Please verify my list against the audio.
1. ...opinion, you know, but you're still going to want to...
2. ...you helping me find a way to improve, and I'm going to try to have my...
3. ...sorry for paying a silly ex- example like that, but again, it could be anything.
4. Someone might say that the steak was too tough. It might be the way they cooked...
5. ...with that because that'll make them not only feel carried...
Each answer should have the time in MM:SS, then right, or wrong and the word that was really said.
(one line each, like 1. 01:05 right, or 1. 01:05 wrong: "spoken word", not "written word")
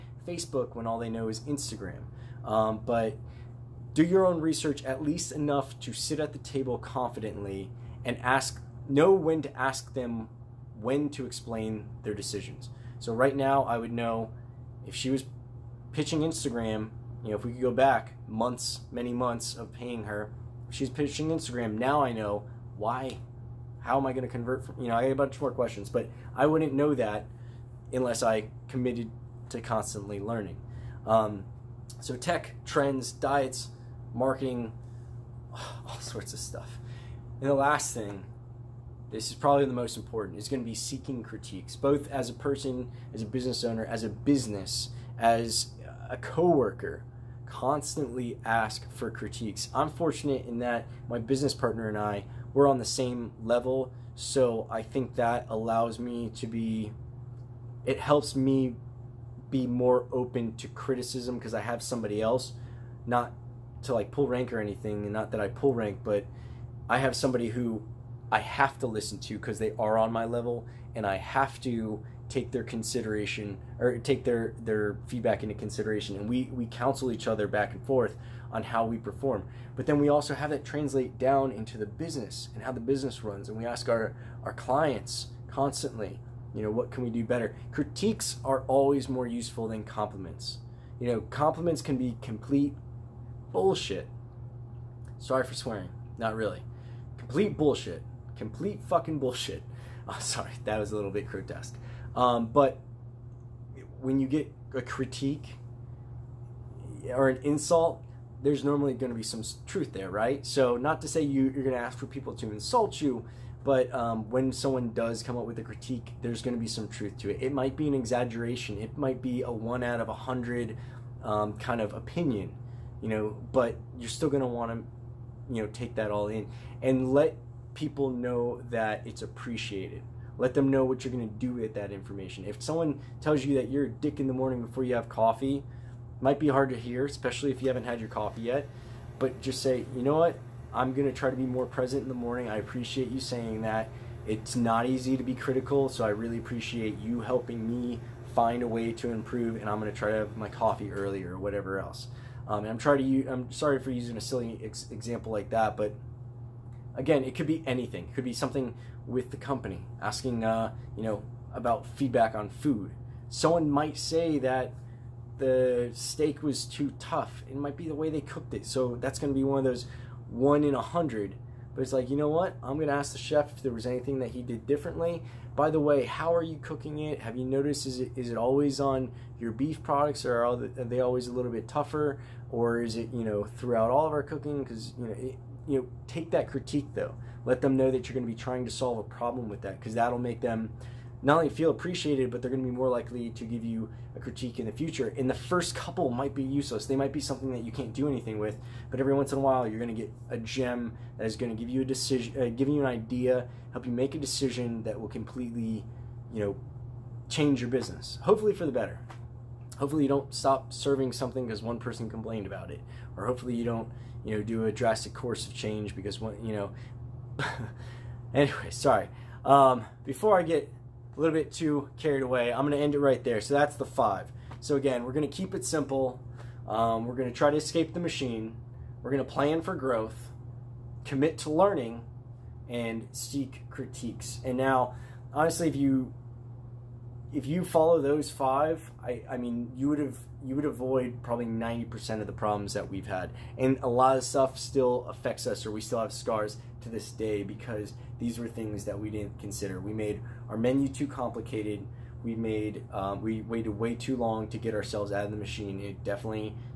1. 02:01 right
2. 02:26 right
3. 02:33 wrong: "using", not "paying"
4. 02:43 right
5. 03:09 wrong: "appreciated", not "carried".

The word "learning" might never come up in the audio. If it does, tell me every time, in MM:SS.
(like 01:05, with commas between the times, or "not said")
00:30, 03:51.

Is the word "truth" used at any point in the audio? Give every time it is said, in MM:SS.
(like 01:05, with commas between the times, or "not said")
01:49, 01:56.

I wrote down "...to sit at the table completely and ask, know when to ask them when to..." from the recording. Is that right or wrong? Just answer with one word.
wrong.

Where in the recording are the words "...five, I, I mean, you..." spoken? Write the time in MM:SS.
03:58.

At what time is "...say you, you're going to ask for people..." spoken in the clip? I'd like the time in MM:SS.
01:51.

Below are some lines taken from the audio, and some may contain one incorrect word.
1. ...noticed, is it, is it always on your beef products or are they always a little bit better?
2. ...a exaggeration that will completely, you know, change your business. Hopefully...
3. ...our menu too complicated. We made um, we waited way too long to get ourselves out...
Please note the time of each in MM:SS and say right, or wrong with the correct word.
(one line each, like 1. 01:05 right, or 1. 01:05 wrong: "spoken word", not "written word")
1. 02:57 wrong: "tougher", not "better"
2. 03:24 wrong: "decision", not "exaggeration"
3. 04:10 right.